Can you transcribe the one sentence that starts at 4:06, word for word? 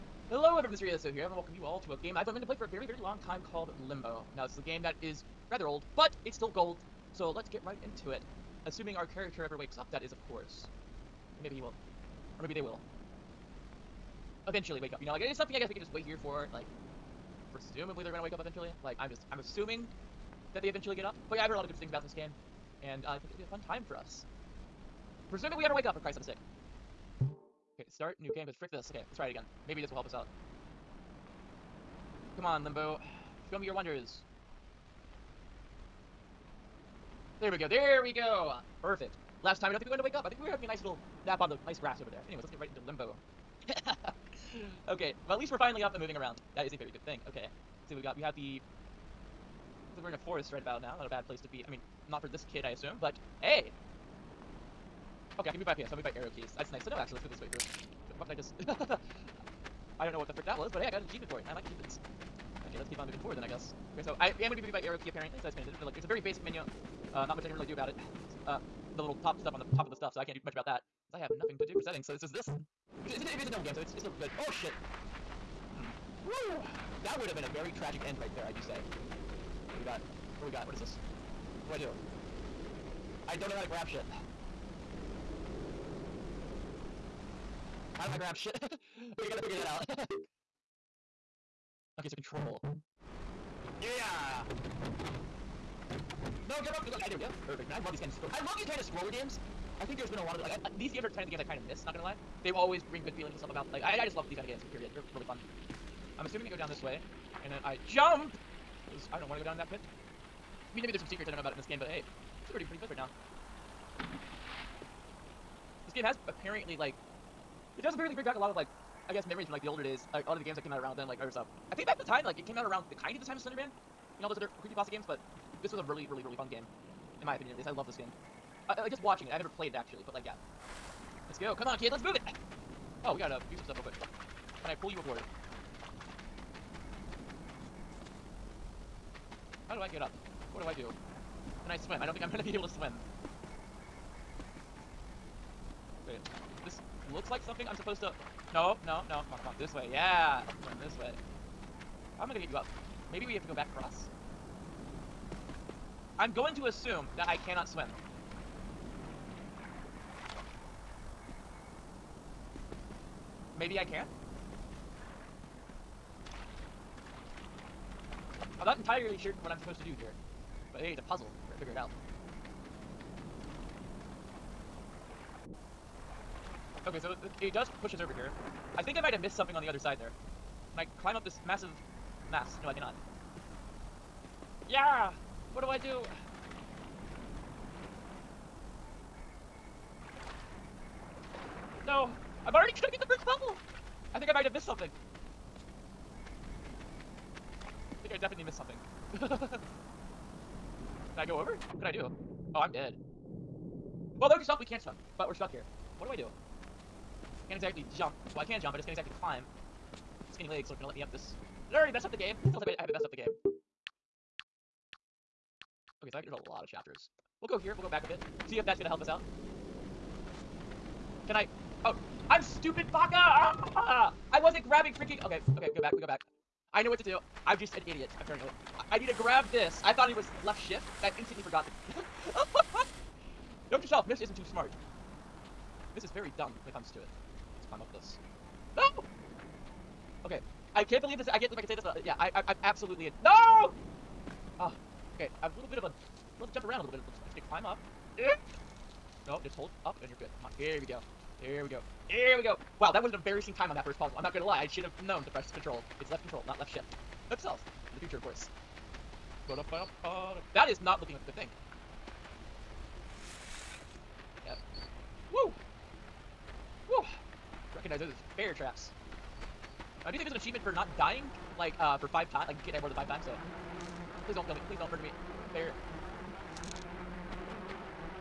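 Love to jump around a little bit.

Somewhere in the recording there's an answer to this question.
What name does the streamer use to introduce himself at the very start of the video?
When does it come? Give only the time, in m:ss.
0:00.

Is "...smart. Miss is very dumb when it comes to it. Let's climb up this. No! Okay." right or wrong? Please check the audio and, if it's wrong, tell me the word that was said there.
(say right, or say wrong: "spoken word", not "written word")
right.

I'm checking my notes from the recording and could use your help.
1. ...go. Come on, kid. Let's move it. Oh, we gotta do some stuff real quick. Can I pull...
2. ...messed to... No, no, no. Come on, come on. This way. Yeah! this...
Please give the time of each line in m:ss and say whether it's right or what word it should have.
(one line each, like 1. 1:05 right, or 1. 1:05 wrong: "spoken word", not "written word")
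1. 2:11 right
2. 2:27 wrong: "supposed", not "messed".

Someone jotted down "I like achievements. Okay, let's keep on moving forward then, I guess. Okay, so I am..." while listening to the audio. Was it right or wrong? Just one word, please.
right.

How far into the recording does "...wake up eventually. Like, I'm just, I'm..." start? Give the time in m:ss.
0:18.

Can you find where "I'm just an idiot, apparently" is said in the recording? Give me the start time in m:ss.
3:47.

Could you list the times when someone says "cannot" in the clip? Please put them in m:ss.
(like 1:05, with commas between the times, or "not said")
2:37, 3:02.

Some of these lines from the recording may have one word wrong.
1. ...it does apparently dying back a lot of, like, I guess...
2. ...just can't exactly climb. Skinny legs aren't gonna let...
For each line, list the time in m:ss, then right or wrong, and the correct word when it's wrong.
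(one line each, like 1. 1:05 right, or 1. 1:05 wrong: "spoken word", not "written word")
1. 1:57 wrong: "bring", not "dying"
2. 3:28 right.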